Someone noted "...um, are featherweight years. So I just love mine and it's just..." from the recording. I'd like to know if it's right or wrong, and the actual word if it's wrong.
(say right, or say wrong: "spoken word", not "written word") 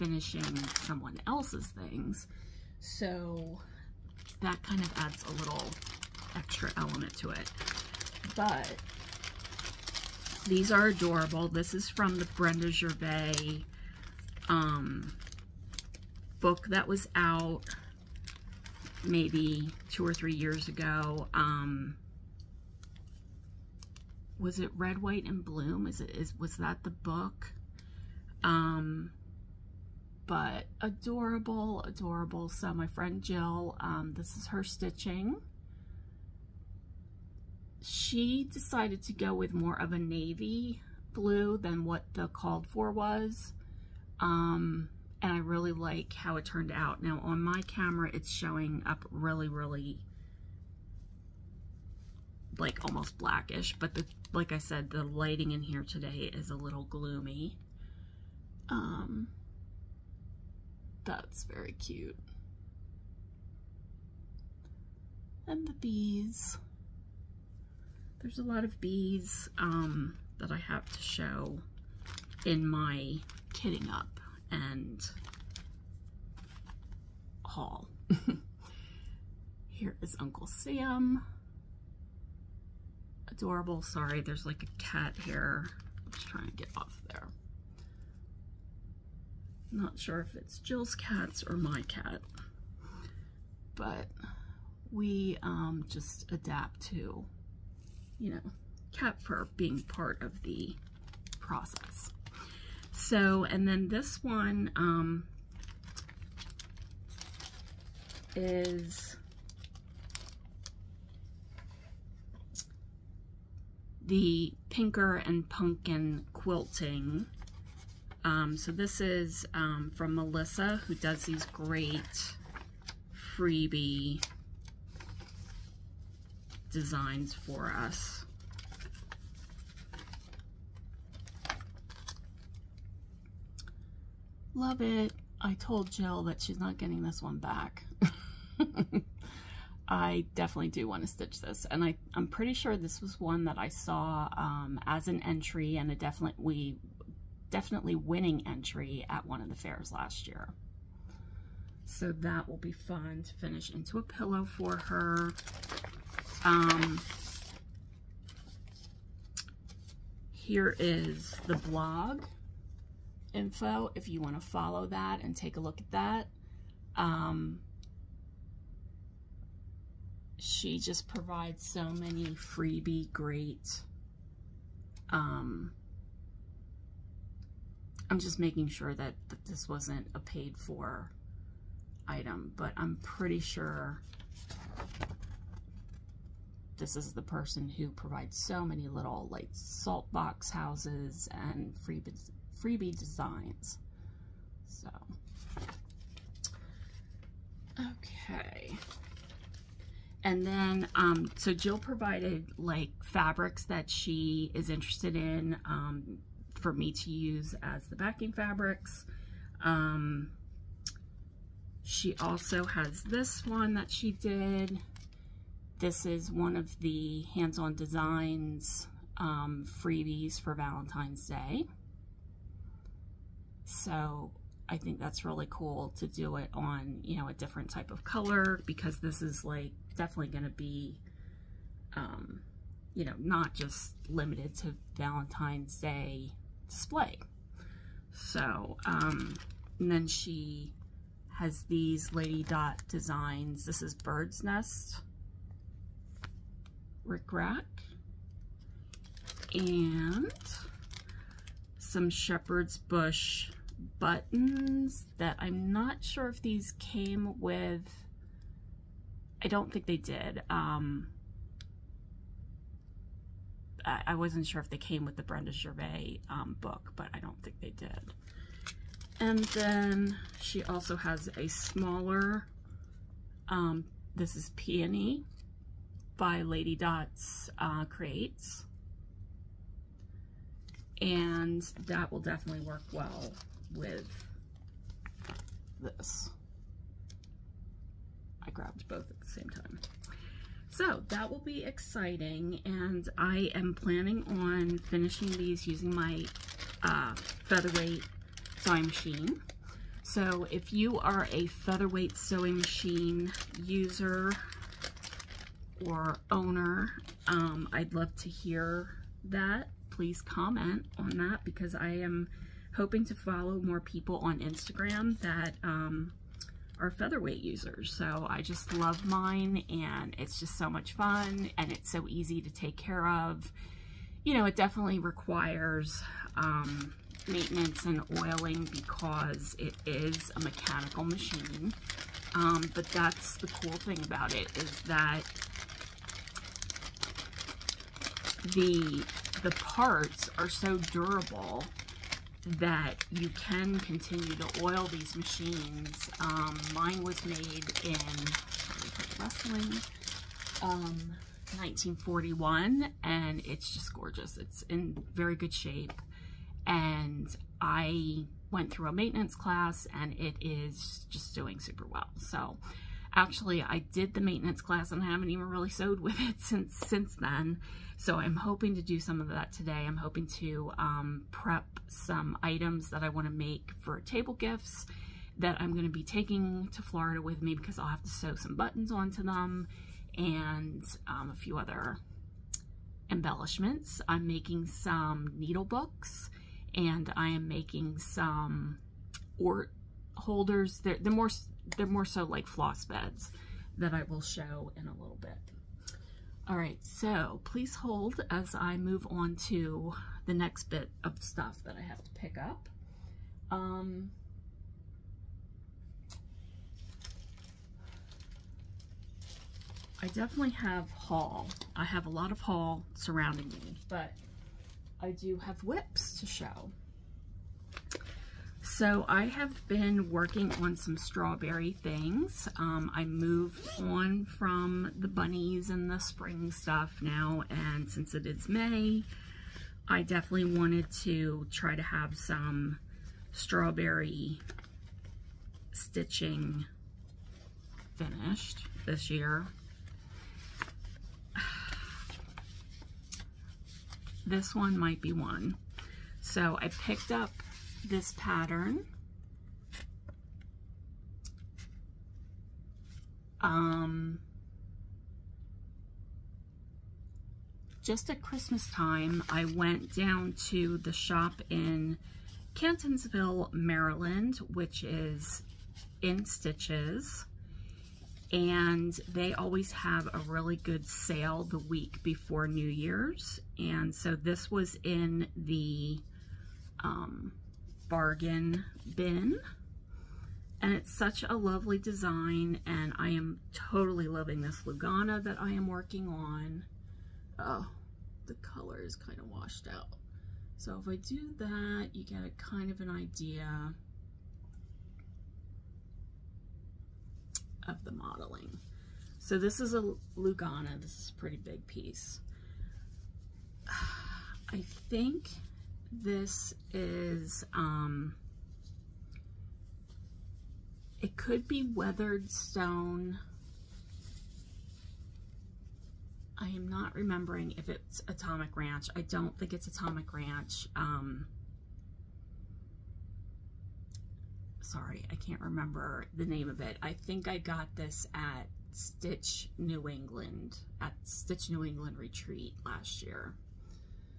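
wrong: "users", not "years".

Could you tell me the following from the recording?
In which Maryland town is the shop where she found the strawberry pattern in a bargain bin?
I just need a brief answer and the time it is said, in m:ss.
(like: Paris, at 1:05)
Catonsville, at 7:42.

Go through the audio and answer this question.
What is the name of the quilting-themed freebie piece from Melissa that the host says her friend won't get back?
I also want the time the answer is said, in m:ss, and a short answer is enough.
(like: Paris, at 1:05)
Pinker and Pumpkin Quilting, at 1:54.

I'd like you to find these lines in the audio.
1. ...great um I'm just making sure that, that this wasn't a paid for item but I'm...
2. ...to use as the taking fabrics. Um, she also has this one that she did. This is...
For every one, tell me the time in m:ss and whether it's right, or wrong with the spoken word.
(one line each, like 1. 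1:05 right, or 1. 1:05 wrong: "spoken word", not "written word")
1. 2:53 right
2. 3:26 wrong: "backing", not "taking".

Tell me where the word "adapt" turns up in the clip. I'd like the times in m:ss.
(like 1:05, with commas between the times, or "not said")
1:36.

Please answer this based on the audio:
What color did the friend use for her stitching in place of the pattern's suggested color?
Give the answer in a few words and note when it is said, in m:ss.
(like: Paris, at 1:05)
Navy blue, at 0:39.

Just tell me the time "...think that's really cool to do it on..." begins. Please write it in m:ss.
3:44.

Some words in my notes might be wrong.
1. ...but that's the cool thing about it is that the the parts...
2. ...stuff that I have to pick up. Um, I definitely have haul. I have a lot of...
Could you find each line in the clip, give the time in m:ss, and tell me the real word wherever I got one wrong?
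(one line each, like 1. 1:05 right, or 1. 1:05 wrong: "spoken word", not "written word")
1. 5:32 right
2. 6:41 right.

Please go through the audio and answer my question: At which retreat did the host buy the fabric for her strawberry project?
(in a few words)
Stitch New England Retreat.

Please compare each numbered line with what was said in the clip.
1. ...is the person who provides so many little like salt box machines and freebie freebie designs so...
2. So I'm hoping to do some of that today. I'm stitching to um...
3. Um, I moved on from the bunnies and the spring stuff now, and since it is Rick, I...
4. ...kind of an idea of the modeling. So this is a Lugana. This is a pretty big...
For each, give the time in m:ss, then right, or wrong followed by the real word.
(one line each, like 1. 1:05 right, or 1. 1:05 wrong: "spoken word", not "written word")
1. 3:06 wrong: "houses", not "machines"
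2. 6:07 wrong: "hoping", not "stitching"
3. 7:02 wrong: "May", not "Rick"
4. 8:12 right.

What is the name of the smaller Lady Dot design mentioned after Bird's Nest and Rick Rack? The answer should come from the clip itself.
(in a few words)
Peony.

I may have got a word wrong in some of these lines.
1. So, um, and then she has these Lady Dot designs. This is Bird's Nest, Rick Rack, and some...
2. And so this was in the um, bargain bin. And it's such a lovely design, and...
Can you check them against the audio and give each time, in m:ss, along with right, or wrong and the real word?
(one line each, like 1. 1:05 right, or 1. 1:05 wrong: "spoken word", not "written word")
1. 3:58 right
2. 7:53 right.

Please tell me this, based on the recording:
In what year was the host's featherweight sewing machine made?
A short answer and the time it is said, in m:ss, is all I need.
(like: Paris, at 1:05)
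1941, at 5:51.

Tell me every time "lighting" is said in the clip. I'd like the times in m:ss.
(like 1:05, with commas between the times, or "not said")
0:55.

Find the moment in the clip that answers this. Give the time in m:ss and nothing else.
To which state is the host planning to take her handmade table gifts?
6:16.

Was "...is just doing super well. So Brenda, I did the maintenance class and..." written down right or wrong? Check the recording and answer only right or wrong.
wrong.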